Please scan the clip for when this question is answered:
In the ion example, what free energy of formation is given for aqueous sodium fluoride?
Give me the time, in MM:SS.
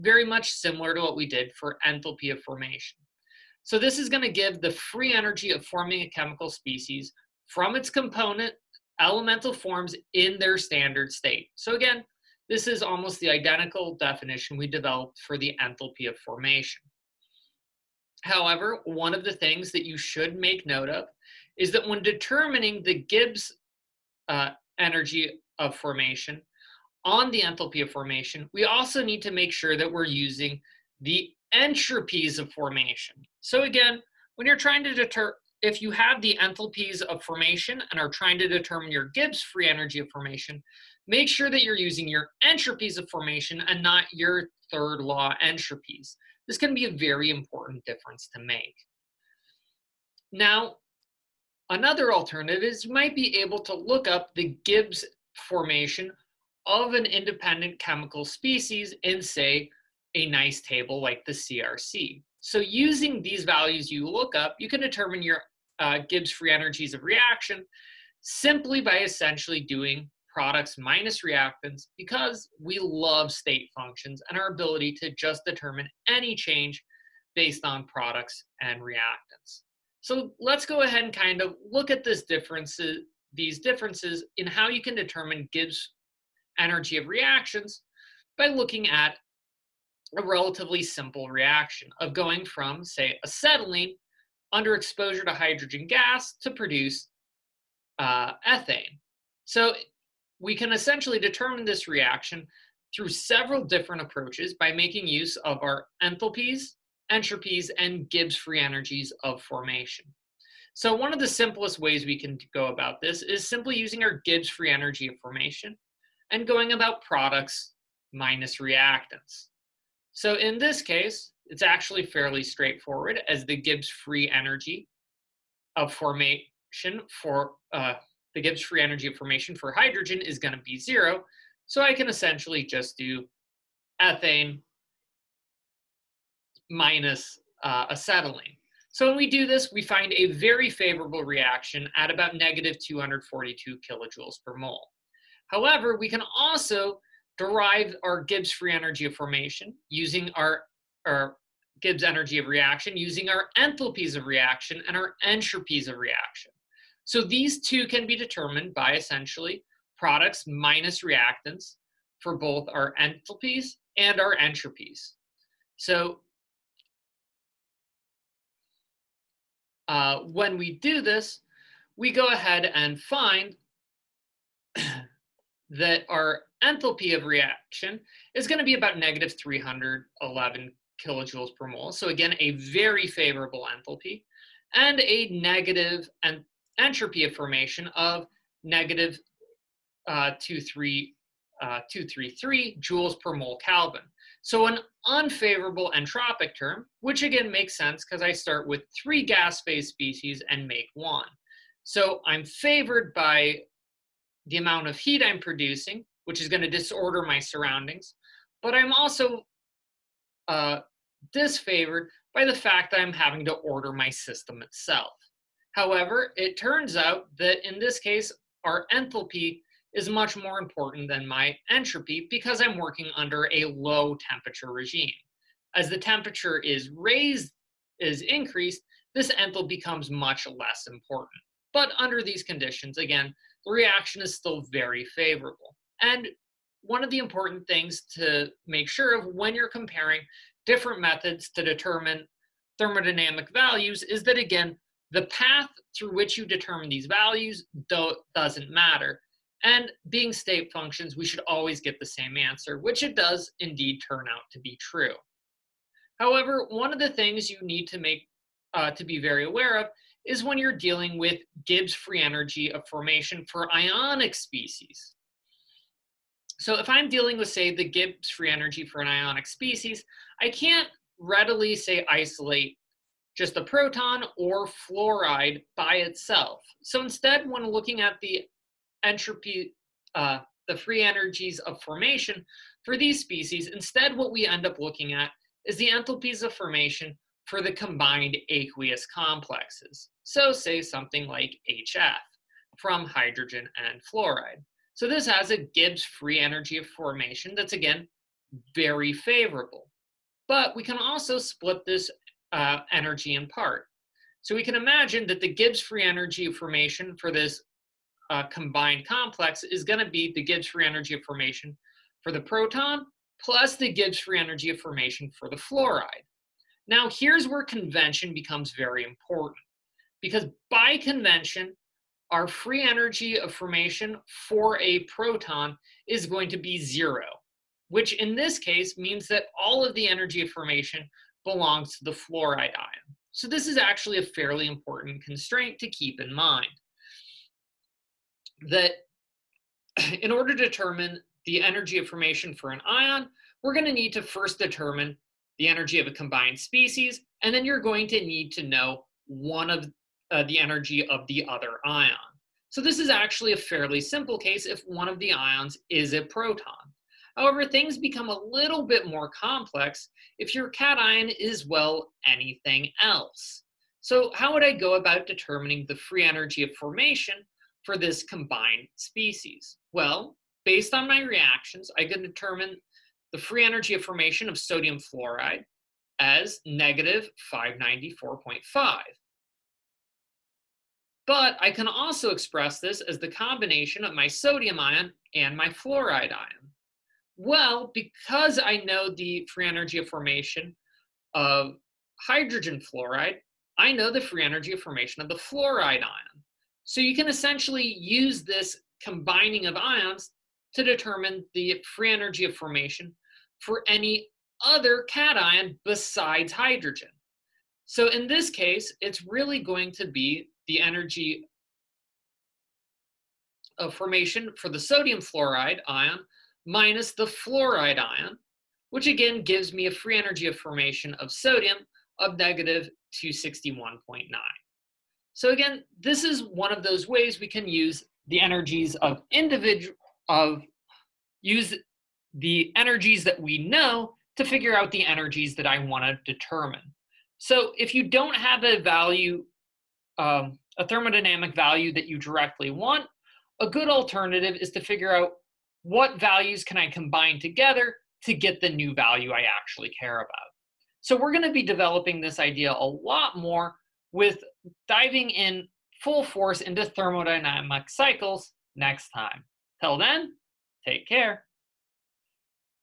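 06:16.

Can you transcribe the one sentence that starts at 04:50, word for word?
So say something like HF from hydrogen and fluoride.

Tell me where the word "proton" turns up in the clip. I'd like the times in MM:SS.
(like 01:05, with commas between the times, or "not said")
04:33, 05:12, 05:25, 05:56.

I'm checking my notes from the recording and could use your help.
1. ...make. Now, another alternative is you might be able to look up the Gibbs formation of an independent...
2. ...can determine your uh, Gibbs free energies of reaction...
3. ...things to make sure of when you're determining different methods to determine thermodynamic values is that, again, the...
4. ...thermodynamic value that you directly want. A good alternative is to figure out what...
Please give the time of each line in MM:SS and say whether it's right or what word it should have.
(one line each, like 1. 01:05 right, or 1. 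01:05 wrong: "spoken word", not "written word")
1. 00:48 right
2. 01:04 right
3. 03:57 wrong: "comparing", not "determining"
4. 07:20 right.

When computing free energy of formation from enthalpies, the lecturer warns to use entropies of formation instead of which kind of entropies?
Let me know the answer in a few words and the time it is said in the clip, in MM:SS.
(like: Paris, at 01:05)
third law entropies, at 00:44.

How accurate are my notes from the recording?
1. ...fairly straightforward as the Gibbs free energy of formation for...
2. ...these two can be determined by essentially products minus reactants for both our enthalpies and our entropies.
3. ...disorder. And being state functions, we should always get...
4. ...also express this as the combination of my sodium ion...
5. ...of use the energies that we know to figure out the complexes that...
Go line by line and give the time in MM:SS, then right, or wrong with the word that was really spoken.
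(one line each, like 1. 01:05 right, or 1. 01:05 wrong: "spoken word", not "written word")
1. 02:02 right
2. 02:37 right
3. 04:08 wrong: "matter", not "disorder"
4. 06:21 right
5. 07:10 wrong: "energies", not "complexes".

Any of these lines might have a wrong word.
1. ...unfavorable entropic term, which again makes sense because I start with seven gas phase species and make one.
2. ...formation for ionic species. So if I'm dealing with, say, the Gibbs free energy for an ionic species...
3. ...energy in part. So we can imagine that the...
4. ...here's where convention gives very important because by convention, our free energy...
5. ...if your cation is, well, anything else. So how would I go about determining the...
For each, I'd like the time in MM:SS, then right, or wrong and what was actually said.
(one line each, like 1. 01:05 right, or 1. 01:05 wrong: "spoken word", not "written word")
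1. 03:15 wrong: "three", not "seven"
2. 04:22 right
3. 05:02 right
4. 05:17 wrong: "becomes", not "gives"
5. 06:00 right.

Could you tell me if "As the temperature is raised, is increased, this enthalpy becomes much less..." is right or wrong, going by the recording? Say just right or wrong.
right.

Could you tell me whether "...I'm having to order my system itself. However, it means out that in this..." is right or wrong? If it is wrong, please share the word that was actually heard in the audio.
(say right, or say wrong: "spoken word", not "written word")
wrong: "turns", not "means".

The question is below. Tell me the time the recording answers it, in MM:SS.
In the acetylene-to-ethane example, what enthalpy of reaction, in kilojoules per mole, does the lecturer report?
02:58.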